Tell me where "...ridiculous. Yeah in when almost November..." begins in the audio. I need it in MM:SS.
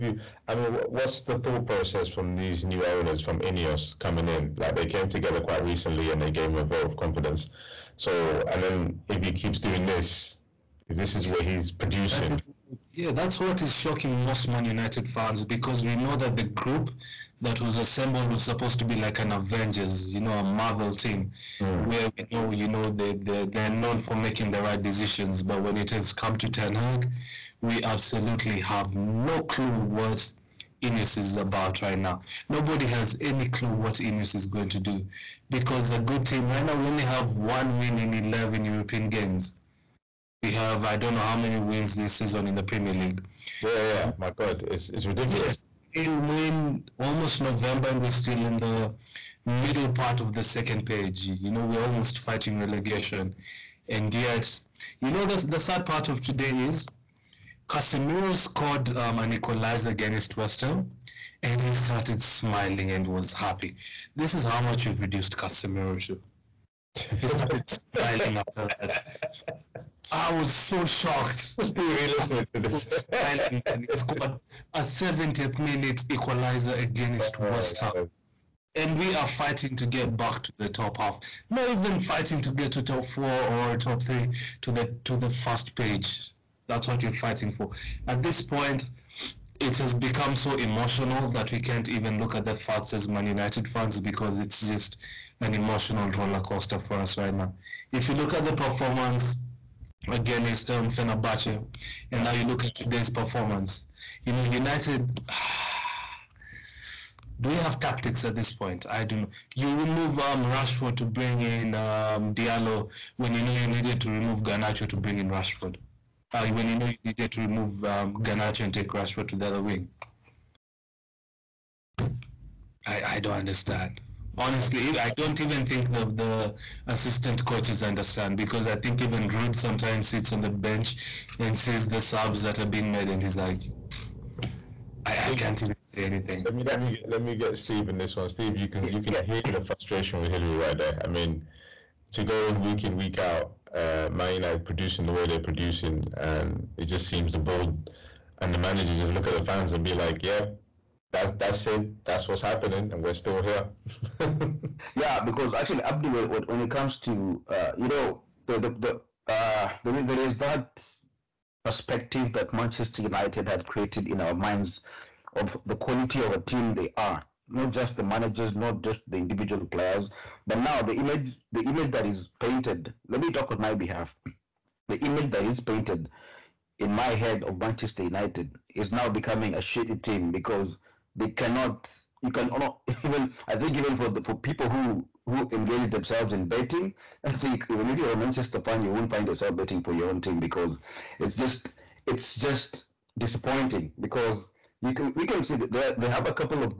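00:45.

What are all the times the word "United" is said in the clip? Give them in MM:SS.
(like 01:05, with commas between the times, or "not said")
00:14, 01:33, 01:44, 02:24, 02:43, 02:58.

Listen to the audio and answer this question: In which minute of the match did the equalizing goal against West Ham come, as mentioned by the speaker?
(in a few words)
70th minute.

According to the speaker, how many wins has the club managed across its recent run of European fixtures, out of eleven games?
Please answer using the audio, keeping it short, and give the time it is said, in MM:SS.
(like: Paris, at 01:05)
1, at 00:37.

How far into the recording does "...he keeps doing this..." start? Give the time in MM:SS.
00:09.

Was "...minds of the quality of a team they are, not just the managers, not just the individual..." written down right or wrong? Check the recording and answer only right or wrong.
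right.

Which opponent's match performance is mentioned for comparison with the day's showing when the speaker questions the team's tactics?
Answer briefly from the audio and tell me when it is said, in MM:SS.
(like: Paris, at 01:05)
Fenerbahce, at 01:40.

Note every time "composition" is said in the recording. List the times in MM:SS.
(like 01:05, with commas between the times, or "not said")
not said.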